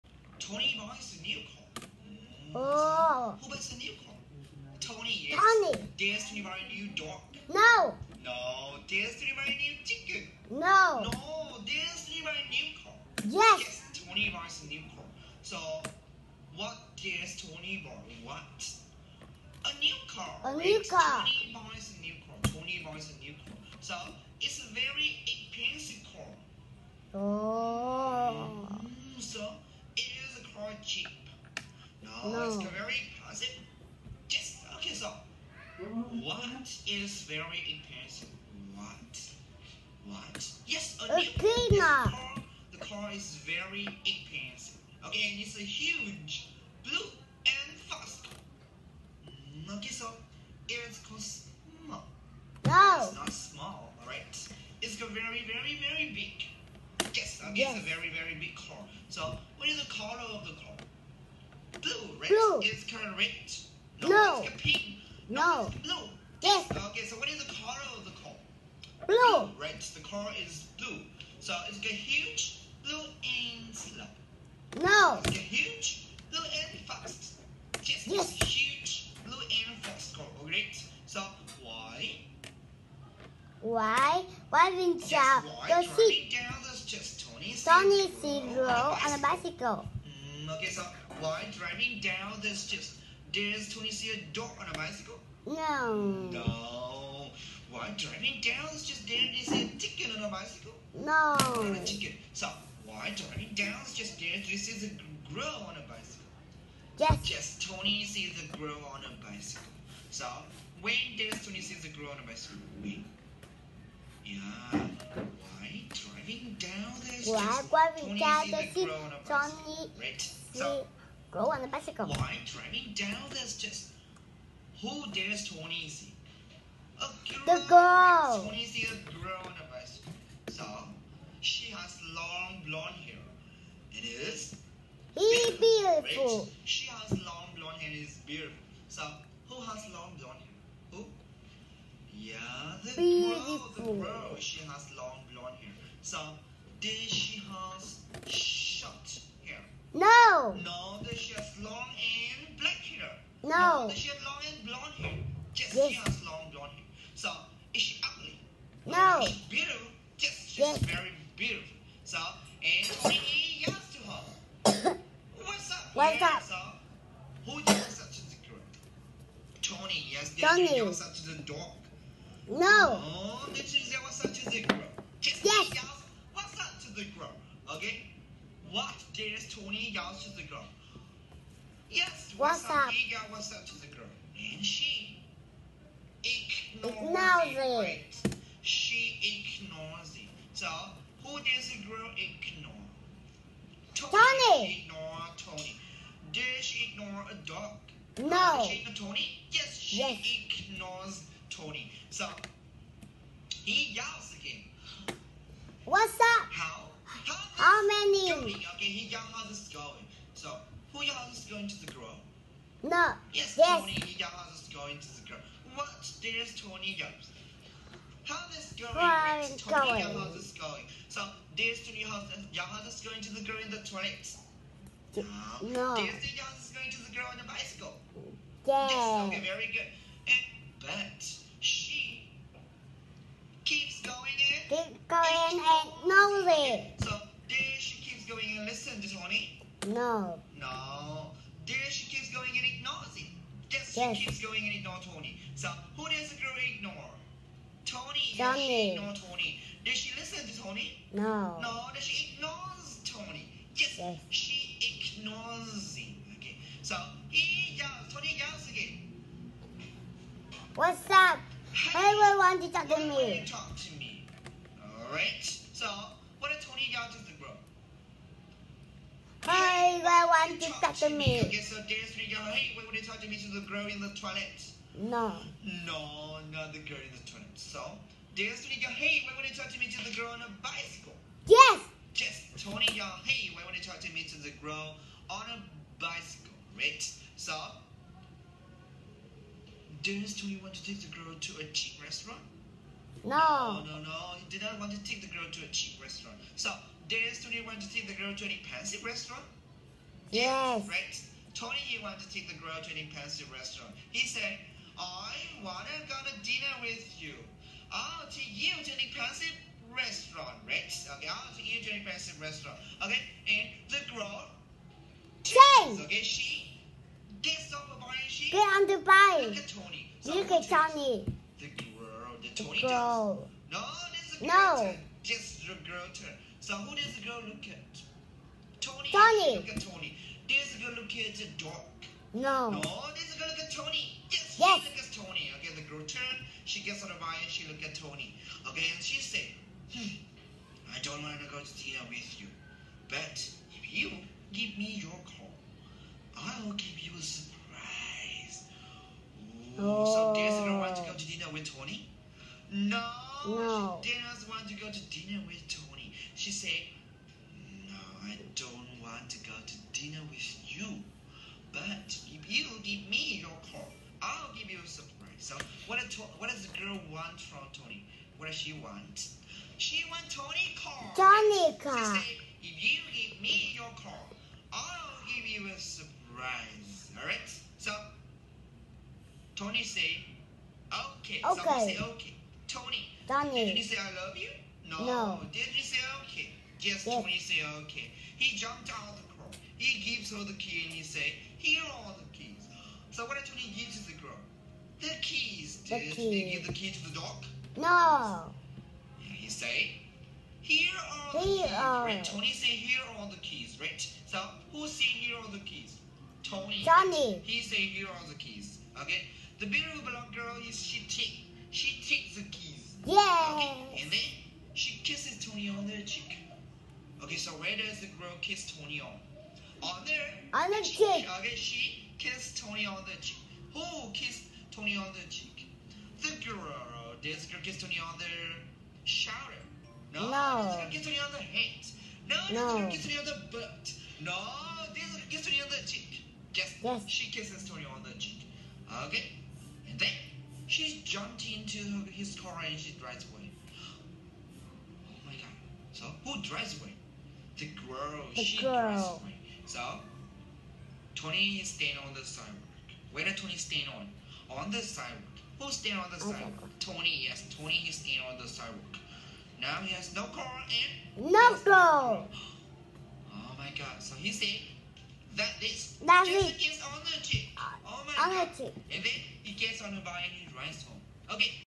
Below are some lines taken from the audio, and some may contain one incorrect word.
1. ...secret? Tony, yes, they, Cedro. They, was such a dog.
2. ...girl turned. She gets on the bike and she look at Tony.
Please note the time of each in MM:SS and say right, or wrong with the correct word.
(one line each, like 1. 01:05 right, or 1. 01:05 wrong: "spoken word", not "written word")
1. 02:48 wrong: "Tony", not "Cedro"
2. 05:35 right.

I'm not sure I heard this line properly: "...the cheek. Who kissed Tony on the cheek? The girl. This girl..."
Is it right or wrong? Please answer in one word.
right.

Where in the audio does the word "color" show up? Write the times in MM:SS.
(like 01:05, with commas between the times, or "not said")
00:59, 01:07.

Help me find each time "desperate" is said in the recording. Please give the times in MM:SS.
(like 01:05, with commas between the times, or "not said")
04:31, 04:38.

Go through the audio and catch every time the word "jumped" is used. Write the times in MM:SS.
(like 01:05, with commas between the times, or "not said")
06:28, 07:21.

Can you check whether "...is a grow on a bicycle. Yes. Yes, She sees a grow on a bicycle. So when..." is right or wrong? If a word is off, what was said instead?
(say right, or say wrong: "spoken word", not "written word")
wrong: "Tony", not "She".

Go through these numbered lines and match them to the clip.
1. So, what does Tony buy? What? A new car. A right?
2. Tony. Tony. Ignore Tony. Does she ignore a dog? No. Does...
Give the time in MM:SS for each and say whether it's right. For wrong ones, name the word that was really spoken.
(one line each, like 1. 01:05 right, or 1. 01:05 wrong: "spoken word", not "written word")
1. 00:15 right
2. 03:13 right.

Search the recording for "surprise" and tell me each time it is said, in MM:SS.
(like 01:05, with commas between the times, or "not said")
05:47, 06:04, 06:15.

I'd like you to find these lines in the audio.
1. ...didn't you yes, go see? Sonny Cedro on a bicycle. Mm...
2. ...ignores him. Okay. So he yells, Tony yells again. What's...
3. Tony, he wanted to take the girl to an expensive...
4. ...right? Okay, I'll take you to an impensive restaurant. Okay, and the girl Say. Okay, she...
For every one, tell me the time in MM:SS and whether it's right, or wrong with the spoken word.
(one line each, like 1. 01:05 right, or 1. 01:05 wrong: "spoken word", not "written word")
1. 01:24 right
2. 04:15 right
3. 05:01 right
4. 05:10 right.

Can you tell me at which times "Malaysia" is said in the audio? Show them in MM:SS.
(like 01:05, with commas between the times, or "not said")
not said.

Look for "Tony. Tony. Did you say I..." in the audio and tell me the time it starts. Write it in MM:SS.
06:22.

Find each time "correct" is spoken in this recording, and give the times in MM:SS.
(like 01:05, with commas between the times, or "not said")
01:02, 01:20.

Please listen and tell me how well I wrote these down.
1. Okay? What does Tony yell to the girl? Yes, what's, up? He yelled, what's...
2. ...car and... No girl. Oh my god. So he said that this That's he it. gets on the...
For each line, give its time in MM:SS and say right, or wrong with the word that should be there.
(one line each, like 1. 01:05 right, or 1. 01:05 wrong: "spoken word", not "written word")
1. 02:57 right
2. 07:40 right.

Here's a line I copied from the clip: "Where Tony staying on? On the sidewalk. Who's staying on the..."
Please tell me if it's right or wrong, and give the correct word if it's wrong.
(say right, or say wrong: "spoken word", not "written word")
right.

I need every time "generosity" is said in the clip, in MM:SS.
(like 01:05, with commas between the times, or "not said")
not said.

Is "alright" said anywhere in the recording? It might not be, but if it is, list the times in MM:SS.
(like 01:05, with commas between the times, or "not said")
00:54.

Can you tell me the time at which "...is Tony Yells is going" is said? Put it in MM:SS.
03:39.